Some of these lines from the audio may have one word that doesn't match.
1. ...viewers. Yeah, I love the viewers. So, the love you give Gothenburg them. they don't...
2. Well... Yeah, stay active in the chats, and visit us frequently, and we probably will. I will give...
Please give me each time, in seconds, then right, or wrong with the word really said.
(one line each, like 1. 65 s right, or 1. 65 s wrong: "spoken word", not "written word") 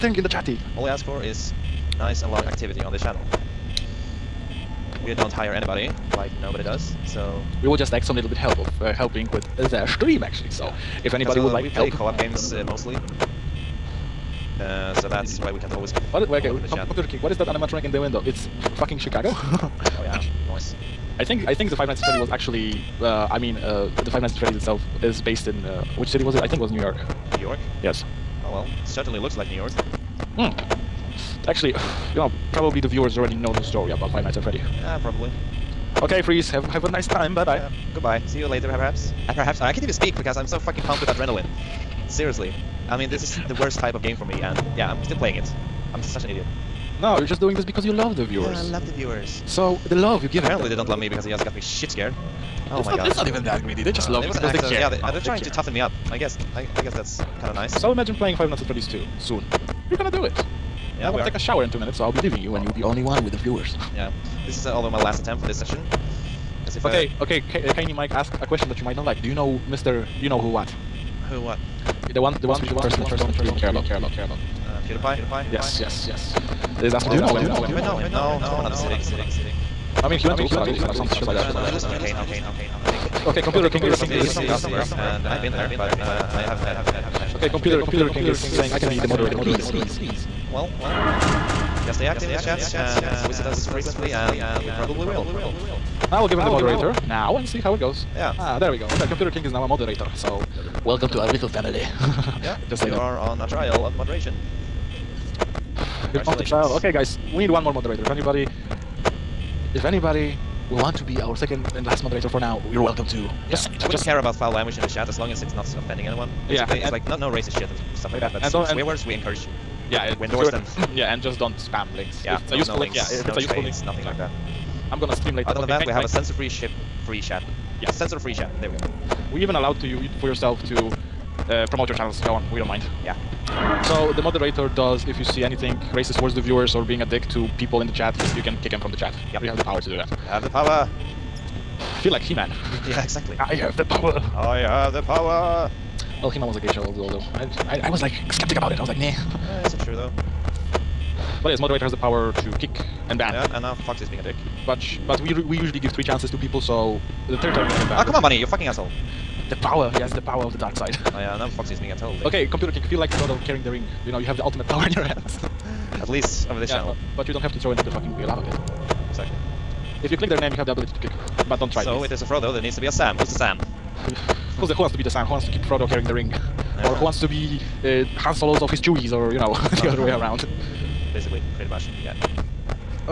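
1. 48 s wrong: "Apparently", not "Gothenburg"
2. 90 s right.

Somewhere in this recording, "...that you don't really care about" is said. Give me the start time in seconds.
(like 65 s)
72 s.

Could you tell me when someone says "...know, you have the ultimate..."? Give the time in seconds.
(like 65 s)
164 s.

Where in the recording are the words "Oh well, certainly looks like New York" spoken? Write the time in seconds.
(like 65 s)
28 s.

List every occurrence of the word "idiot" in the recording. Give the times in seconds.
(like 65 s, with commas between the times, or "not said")
46 s.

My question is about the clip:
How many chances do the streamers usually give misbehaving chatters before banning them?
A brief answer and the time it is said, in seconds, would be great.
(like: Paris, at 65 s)
3, at 155 s.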